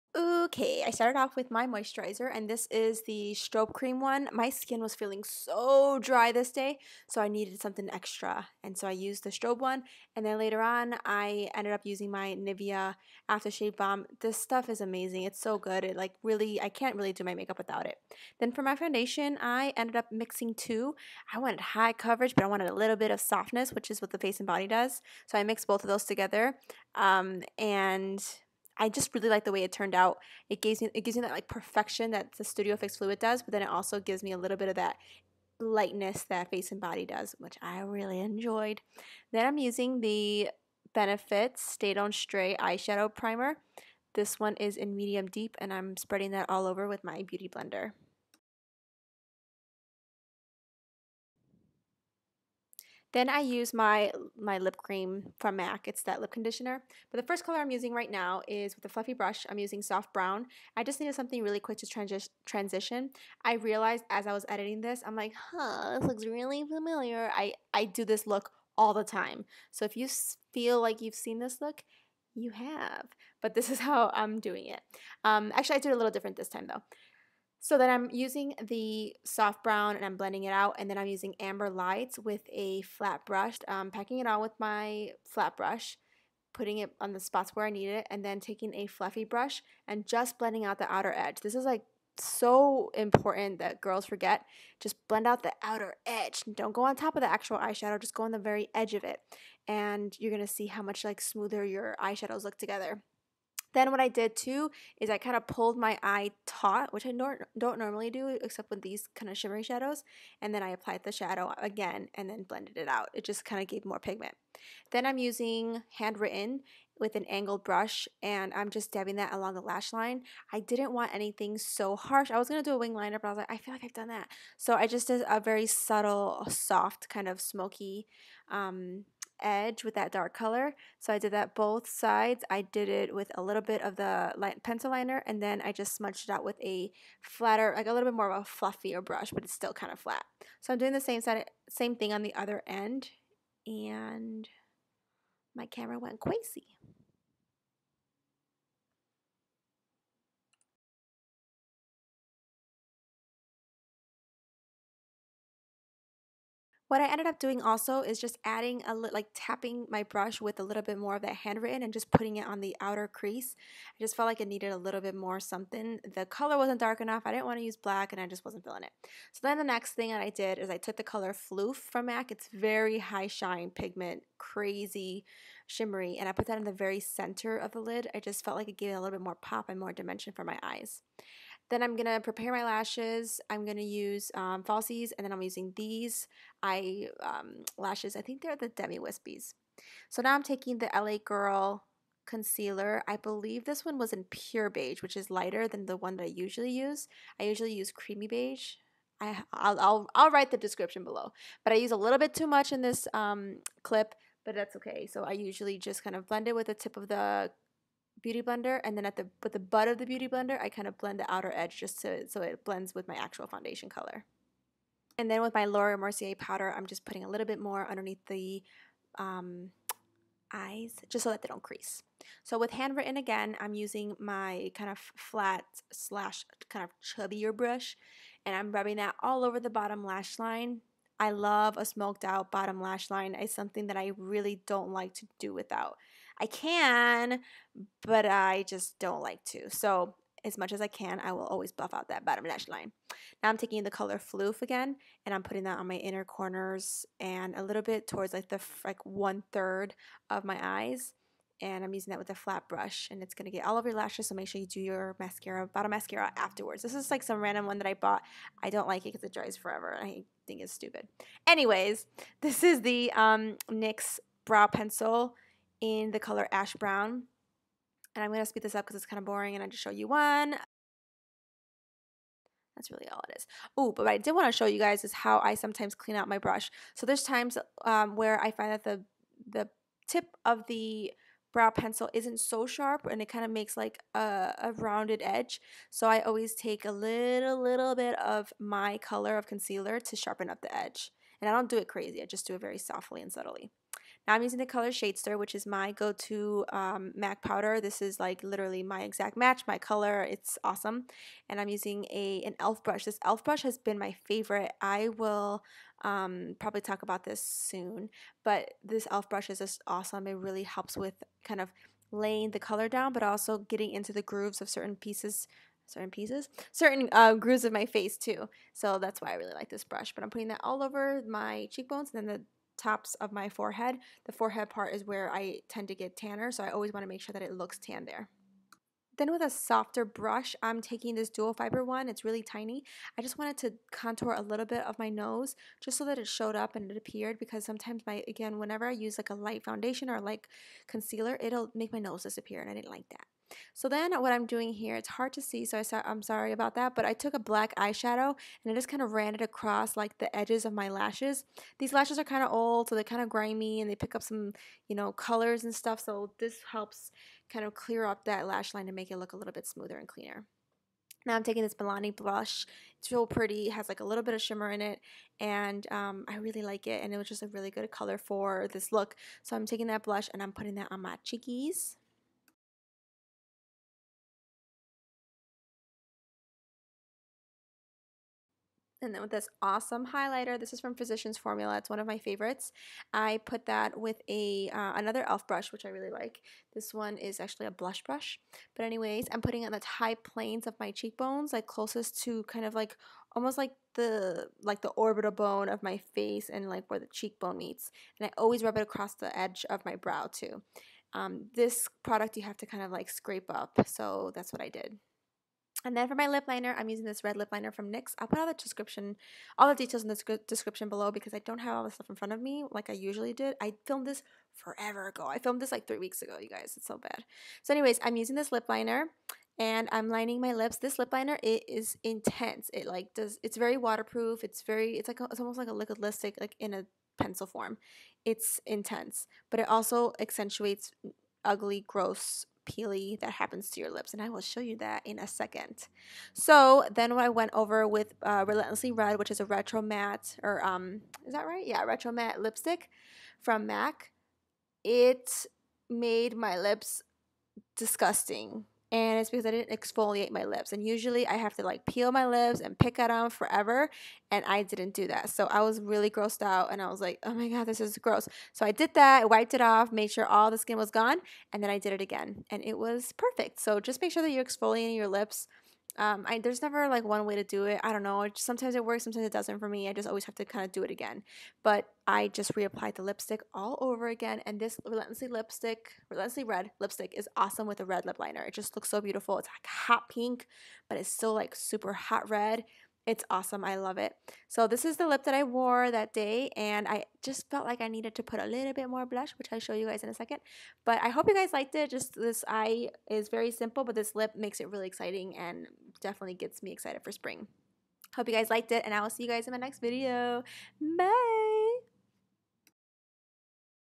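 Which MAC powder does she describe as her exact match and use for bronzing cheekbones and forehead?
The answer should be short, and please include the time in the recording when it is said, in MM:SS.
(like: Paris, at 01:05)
Shadester, at 04:54.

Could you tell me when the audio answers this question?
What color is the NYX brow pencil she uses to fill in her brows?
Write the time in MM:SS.
04:26.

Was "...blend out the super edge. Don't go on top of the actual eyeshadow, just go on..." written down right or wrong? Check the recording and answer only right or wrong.
wrong.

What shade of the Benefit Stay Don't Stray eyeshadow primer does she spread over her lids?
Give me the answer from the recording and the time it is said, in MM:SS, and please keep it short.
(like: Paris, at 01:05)
medium deep, at 00:44.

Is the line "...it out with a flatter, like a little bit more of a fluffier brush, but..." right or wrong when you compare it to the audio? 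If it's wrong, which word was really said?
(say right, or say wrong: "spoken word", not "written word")
right.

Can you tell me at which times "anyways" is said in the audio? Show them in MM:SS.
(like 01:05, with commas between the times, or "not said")
04:21, 06:28, 06:57.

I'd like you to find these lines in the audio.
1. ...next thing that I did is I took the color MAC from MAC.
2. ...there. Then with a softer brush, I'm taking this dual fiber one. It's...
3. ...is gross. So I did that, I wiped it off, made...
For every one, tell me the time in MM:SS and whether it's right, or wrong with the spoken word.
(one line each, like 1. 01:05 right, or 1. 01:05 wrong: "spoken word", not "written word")
1. 02:49 wrong: "Phloof", not "MAC"
2. 05:28 right
3. 07:37 right.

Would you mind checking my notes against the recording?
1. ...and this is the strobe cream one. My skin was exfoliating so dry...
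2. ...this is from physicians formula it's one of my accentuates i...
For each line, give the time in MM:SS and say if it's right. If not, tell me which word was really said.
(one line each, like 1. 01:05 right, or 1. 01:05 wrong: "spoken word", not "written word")
1. 00:02 wrong: "feeling", not "exfoliating"
2. 06:20 wrong: "favorites", not "accentuates".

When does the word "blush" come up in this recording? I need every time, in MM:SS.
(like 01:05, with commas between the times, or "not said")
06:02, 06:10, 06:27, 08:09.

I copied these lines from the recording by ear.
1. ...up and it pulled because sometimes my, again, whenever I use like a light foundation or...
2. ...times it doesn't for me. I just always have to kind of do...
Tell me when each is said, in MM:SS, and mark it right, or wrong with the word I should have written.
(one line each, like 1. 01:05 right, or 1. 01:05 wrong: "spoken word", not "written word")
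1. 05:36 wrong: "appeared", not "pulled"
2. 07:49 wrong: "sometimes", not "times".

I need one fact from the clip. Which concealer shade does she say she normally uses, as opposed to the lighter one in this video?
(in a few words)
creamy beige.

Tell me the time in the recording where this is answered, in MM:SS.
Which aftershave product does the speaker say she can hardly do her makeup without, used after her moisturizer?
00:12.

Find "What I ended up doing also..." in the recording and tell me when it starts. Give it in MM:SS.
02:36.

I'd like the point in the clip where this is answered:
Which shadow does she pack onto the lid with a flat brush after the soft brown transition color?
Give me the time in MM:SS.
01:21.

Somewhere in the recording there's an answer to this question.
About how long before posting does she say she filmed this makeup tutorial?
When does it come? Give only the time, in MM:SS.
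06:55.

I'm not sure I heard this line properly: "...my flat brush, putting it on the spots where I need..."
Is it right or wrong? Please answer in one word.
right.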